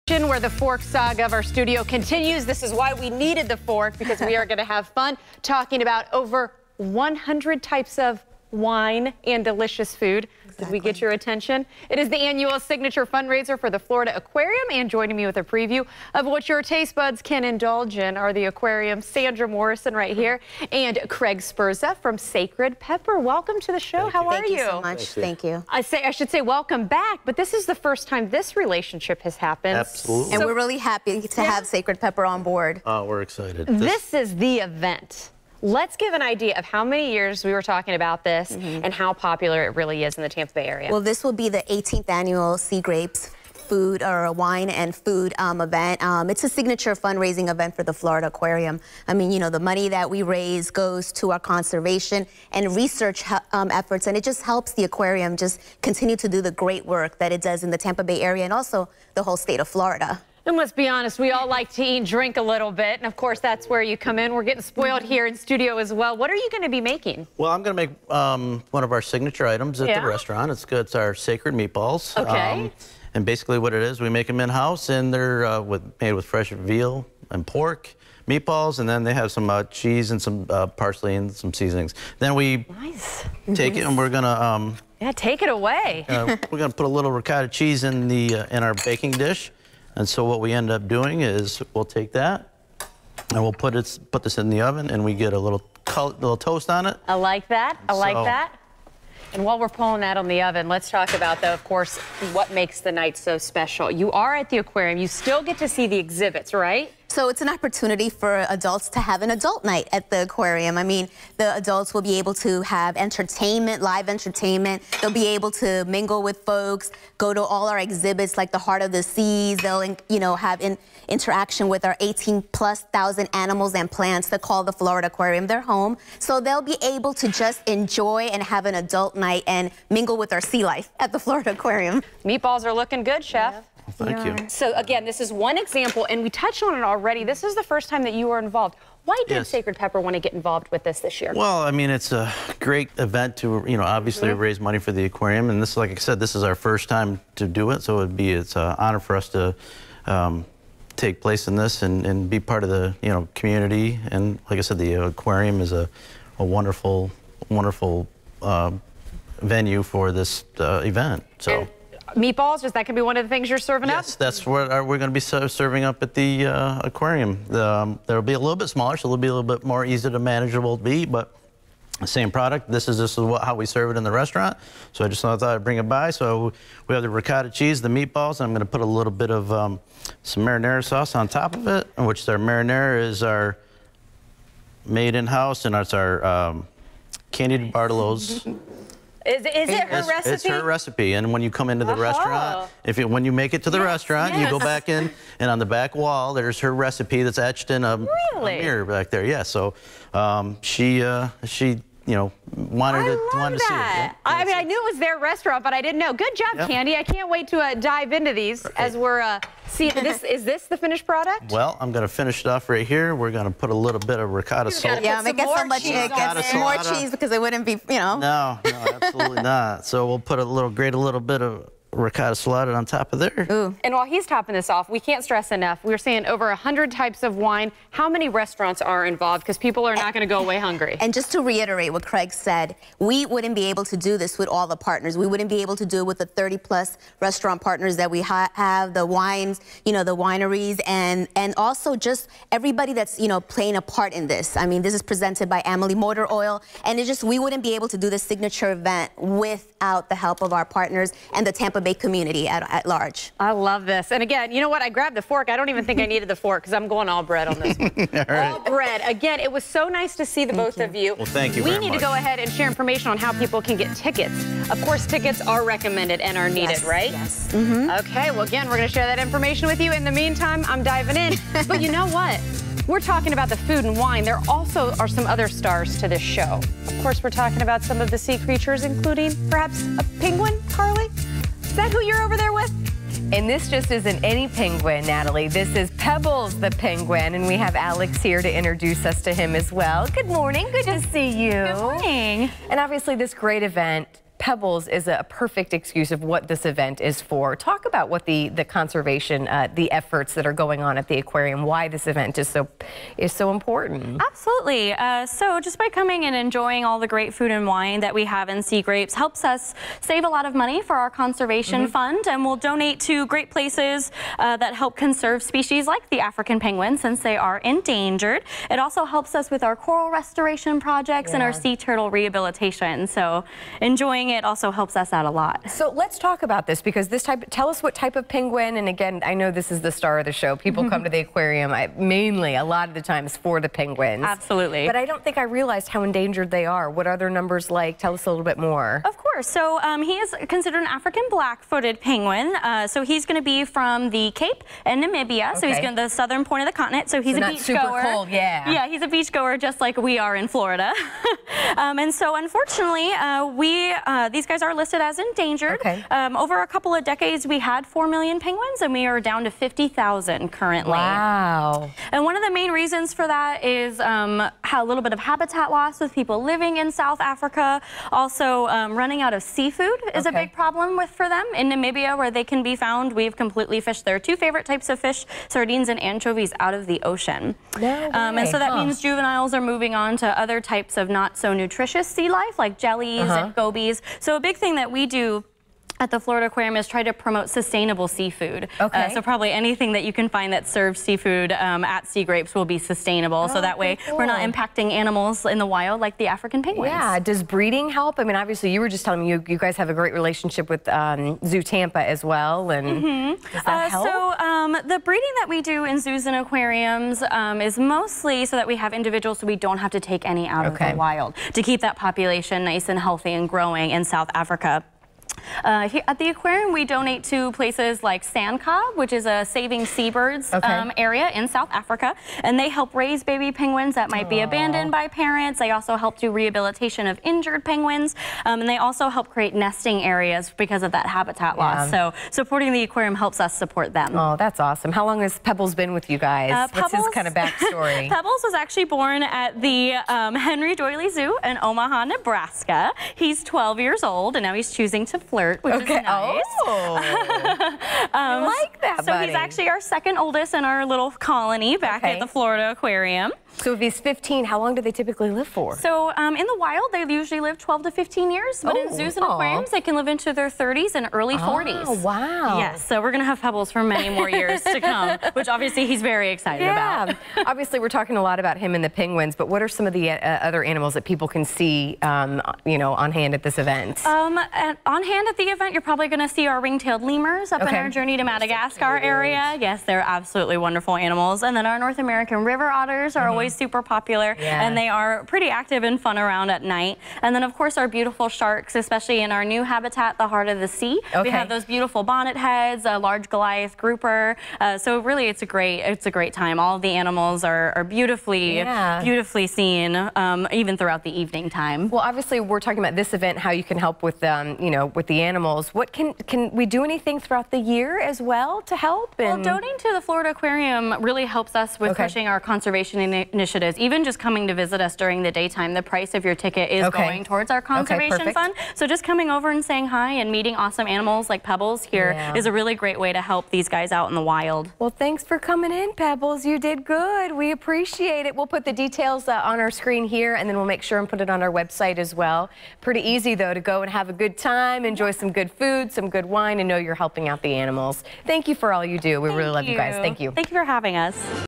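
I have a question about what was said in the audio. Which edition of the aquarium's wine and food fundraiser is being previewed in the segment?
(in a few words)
18th.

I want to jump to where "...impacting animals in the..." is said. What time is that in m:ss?
6:34.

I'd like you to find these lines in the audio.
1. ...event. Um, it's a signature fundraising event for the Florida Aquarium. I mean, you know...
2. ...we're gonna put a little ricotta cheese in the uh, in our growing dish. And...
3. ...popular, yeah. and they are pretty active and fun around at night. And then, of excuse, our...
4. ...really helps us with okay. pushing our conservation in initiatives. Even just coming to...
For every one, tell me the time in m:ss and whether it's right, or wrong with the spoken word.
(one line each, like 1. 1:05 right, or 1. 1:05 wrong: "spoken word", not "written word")
1. 0:45 right
2. 1:26 wrong: "baking", not "growing"
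3. 8:03 wrong: "course", not "excuse"
4. 8:31 right.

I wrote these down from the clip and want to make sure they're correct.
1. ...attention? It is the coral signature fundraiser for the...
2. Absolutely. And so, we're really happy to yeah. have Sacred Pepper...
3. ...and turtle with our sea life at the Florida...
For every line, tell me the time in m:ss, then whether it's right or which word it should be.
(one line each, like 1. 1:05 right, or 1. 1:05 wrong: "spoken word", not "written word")
1. 0:11 wrong: "annual", not "coral"
2. 0:29 right
3. 2:09 wrong: "mingle", not "turtle".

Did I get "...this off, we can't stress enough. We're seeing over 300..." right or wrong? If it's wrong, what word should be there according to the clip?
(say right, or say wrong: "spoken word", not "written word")
wrong: "100", not "300".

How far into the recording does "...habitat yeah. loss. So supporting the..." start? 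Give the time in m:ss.
7:11.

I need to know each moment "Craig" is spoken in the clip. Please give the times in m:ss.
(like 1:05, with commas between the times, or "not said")
0:21, 3:52.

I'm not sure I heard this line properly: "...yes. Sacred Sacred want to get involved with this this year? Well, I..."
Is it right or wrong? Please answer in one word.
wrong.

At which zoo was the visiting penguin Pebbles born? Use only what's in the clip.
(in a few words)
Henry Doorly Zoo.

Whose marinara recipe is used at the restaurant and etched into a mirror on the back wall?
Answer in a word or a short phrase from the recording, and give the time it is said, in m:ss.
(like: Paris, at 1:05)
Candy Bartolo, at 3:07.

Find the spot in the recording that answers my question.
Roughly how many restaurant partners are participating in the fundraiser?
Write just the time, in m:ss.
3:56.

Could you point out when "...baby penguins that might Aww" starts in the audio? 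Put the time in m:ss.
7:03.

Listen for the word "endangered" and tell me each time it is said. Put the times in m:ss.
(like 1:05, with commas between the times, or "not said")
5:17, 5:36, 5:55.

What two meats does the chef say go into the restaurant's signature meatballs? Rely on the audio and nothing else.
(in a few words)
veal and pork.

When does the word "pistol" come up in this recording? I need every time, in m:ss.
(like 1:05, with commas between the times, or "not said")
not said.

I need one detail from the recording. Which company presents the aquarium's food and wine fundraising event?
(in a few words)
Amalie Motor Oil.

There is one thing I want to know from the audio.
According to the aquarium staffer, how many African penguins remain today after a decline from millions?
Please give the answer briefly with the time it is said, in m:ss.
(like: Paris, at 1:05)
50,000, at 5:59.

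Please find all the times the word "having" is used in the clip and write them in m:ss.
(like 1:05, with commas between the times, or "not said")
9:00.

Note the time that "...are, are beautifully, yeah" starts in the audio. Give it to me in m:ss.
8:17.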